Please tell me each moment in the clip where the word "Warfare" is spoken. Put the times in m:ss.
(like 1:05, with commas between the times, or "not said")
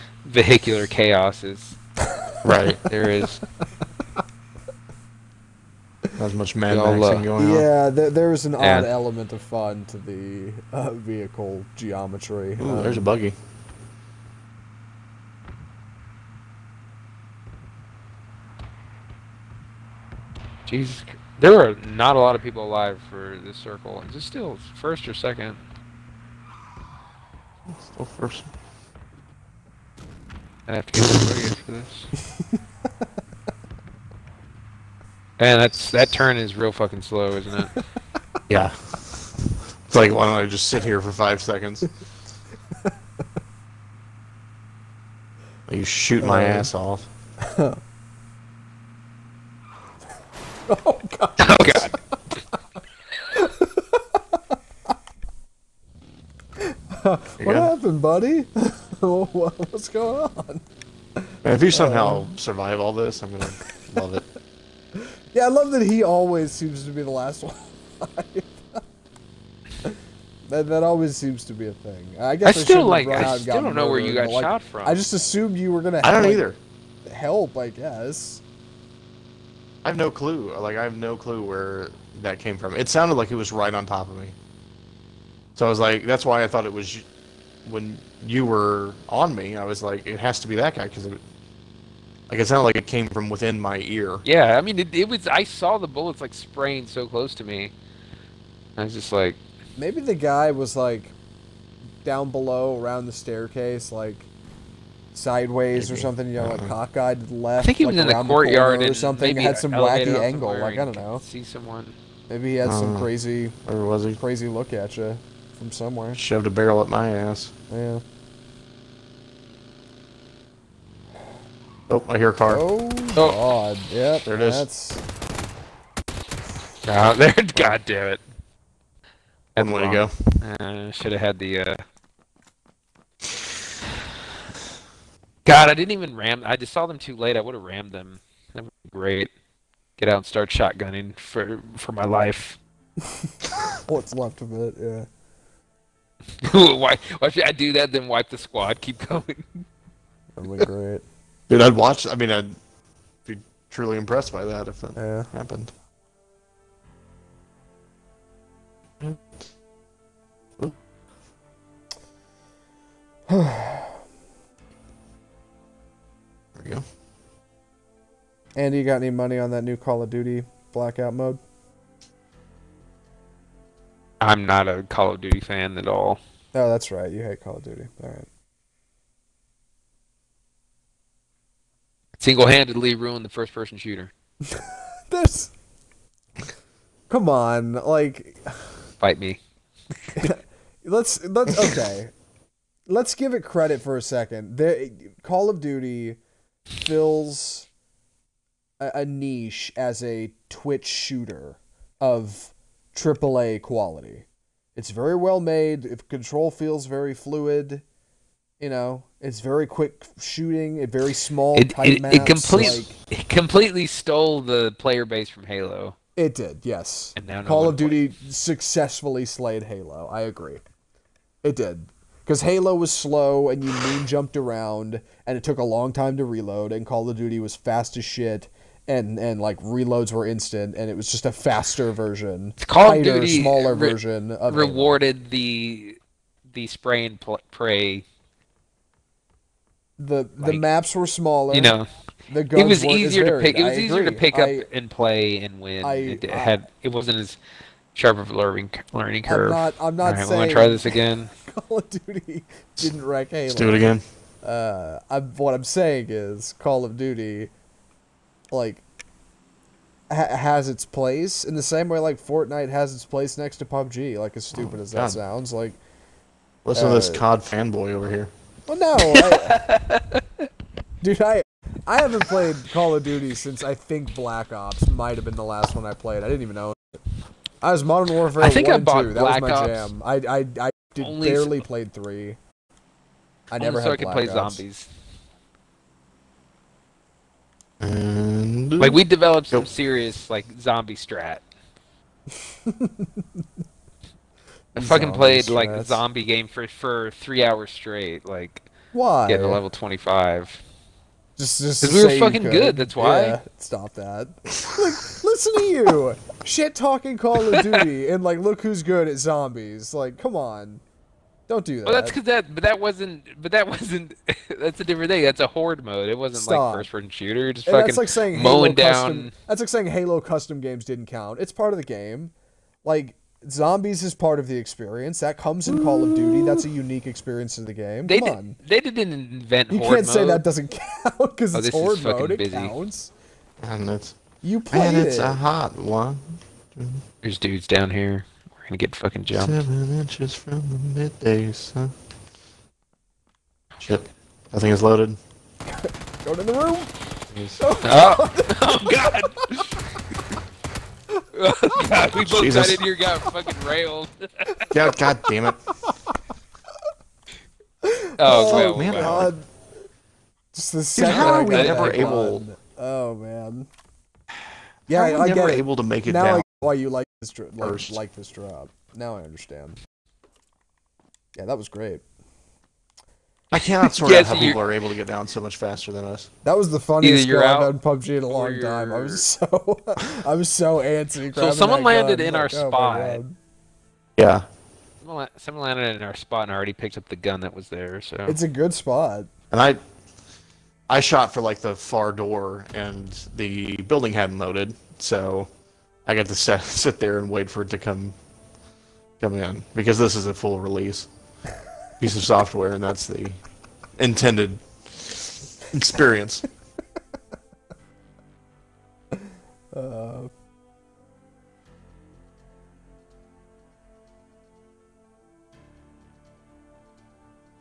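4:38.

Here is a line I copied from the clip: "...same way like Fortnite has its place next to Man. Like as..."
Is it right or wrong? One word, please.
wrong.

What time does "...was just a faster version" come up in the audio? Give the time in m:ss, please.
3:50.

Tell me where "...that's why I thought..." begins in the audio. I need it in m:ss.
1:26.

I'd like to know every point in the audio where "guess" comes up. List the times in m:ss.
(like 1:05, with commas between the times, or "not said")
1:12, 1:17.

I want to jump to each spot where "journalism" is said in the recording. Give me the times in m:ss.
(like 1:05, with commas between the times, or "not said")
not said.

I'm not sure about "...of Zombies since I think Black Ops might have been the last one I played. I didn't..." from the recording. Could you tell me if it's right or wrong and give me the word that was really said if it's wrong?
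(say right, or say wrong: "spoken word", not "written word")
wrong: "Duty", not "Zombies".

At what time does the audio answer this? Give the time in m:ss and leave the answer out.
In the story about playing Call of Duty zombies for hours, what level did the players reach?
4:59.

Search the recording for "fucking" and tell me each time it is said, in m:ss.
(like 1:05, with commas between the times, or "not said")
0:36, 4:54, 5:02, 5:17, 5:38, 5:53.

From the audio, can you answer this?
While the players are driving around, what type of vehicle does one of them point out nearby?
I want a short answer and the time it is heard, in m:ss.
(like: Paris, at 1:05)
Buggy, at 0:12.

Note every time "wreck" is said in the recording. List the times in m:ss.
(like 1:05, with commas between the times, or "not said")
4:13.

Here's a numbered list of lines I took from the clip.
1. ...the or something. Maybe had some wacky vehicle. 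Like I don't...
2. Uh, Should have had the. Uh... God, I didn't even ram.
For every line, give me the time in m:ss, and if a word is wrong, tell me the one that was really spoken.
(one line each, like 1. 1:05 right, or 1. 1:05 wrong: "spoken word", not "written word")
1. 1:48 wrong: "angle", not "vehicle"
2. 2:10 right.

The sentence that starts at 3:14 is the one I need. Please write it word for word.
The Call of Duty fills a, a niche as a Twitch shooter of AAA quality.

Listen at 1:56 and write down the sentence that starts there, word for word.
Shoved a barrel up my ass.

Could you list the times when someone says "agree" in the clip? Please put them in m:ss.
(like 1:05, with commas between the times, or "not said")
3:40, 4:03.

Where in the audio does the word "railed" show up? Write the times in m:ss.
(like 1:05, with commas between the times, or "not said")
5:53.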